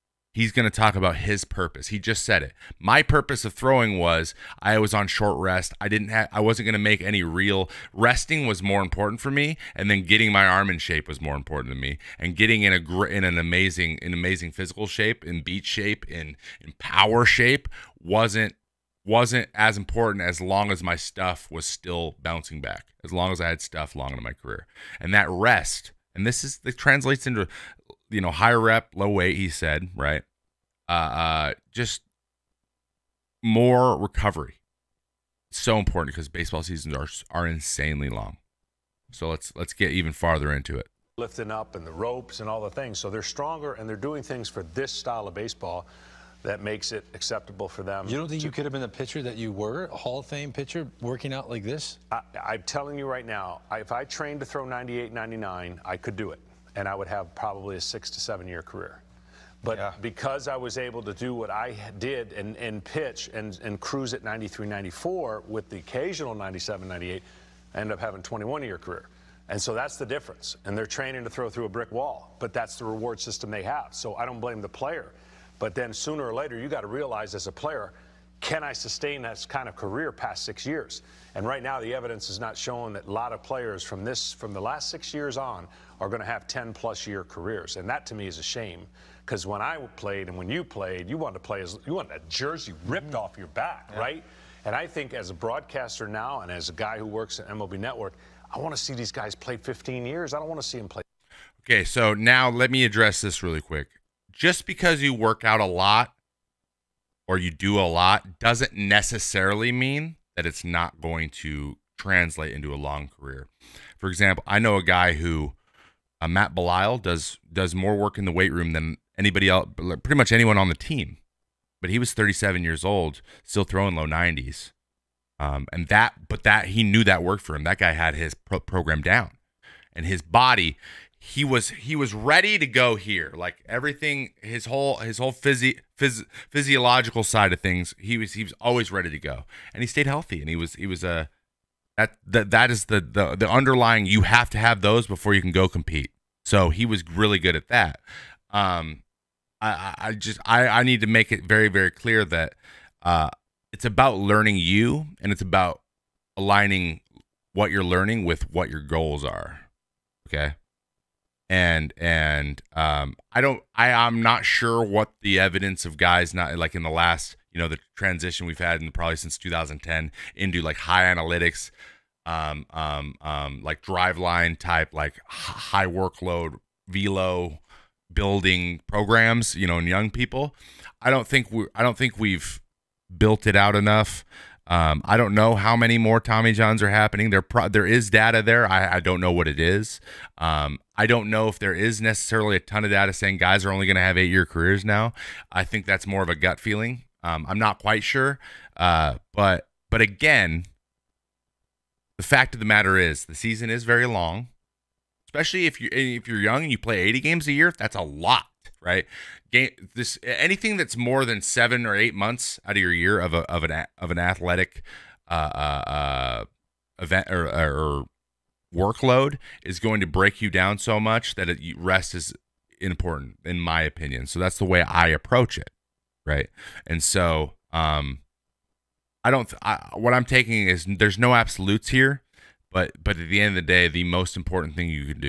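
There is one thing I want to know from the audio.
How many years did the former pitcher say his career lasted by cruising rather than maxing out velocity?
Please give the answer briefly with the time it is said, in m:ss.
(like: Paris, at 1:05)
21 years, at 1:08.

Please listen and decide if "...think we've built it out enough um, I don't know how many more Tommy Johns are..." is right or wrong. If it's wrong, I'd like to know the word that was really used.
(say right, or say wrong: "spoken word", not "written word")
right.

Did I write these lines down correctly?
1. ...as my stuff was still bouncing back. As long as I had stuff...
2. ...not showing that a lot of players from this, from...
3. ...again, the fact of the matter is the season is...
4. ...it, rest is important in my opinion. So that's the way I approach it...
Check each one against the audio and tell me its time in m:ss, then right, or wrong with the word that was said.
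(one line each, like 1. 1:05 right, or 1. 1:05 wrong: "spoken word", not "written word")
1. 0:20 right
2. 1:22 right
3. 3:20 right
4. 3:41 right.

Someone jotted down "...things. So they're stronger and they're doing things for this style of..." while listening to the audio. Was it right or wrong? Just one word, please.
right.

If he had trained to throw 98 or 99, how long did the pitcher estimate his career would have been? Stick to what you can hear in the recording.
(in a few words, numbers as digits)
6 to 7 years.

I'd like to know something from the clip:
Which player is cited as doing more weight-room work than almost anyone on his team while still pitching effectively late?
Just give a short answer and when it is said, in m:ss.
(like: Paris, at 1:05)
Matt Belisle, at 1:56.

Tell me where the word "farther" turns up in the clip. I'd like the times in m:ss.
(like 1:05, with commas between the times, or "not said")
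0:40.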